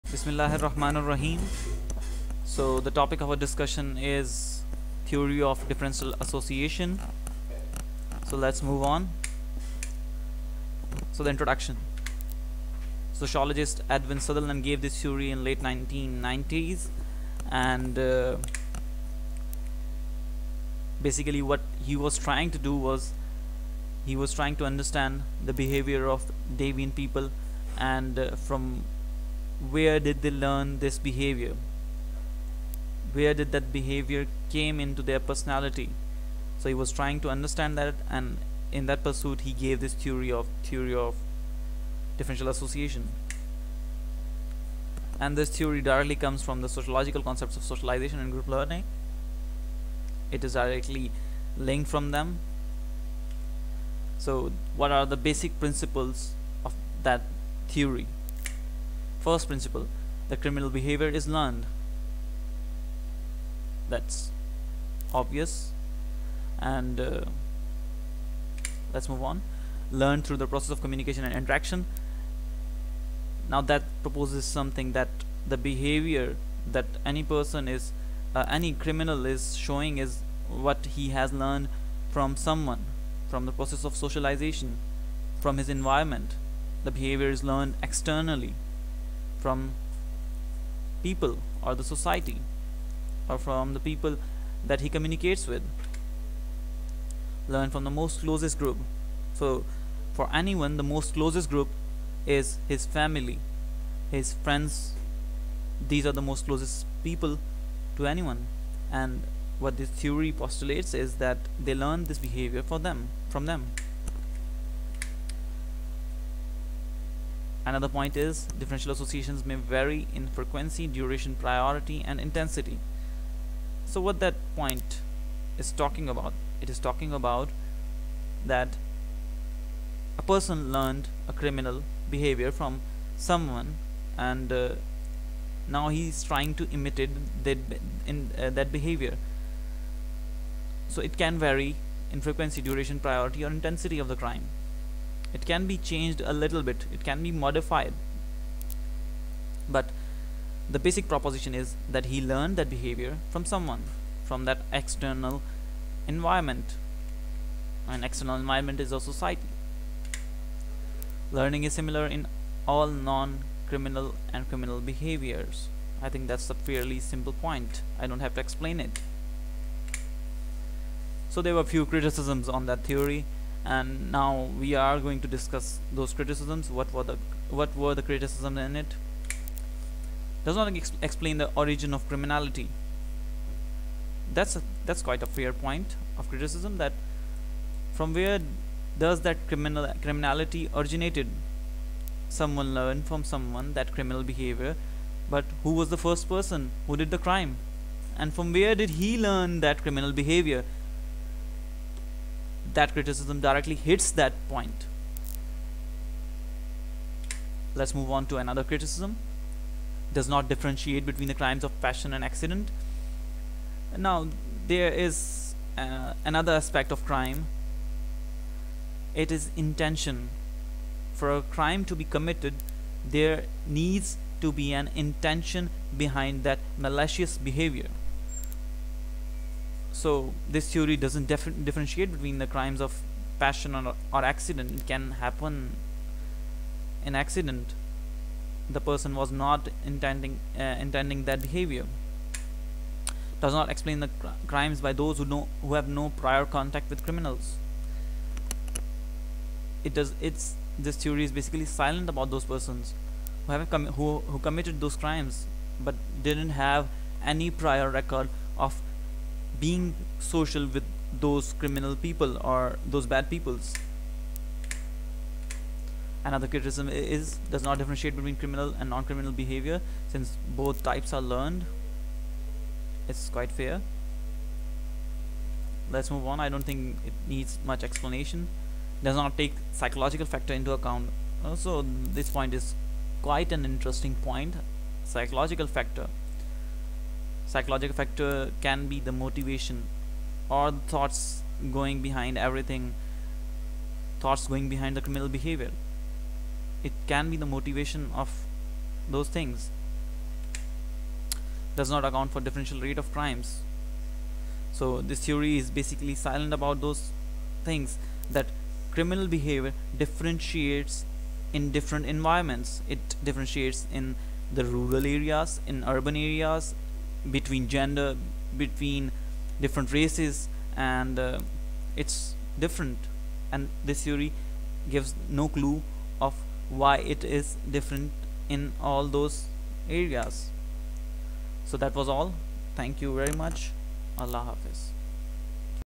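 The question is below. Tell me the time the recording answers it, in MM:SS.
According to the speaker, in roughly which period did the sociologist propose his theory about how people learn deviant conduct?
00:15.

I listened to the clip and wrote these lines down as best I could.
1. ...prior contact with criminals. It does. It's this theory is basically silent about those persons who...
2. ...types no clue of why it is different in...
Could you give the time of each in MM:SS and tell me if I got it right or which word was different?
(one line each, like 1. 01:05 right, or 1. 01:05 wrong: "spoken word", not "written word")
1. 04:06 right
2. 05:24 wrong: "gives", not "types".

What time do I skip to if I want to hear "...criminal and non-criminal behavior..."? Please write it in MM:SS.
04:28.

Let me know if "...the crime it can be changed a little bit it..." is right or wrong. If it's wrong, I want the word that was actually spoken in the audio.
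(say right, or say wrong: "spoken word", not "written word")
right.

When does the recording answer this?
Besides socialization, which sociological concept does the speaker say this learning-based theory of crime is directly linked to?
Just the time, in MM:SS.
00:48.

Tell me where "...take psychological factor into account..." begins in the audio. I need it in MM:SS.
04:39.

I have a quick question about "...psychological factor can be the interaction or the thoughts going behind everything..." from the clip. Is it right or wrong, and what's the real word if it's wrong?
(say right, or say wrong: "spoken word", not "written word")
wrong: "motivation", not "interaction".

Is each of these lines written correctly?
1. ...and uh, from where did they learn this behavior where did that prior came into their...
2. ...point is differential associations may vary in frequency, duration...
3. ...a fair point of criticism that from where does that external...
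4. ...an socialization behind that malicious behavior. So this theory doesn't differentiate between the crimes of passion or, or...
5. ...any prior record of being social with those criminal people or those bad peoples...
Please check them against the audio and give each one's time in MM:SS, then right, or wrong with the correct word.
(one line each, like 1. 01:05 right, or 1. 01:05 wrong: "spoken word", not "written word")
1. 00:27 wrong: "behavior", not "prior"
2. 01:57 right
3. 03:05 wrong: "criminal", not "external"
4. 03:44 wrong: "intention", not "socialization"
5. 04:17 right.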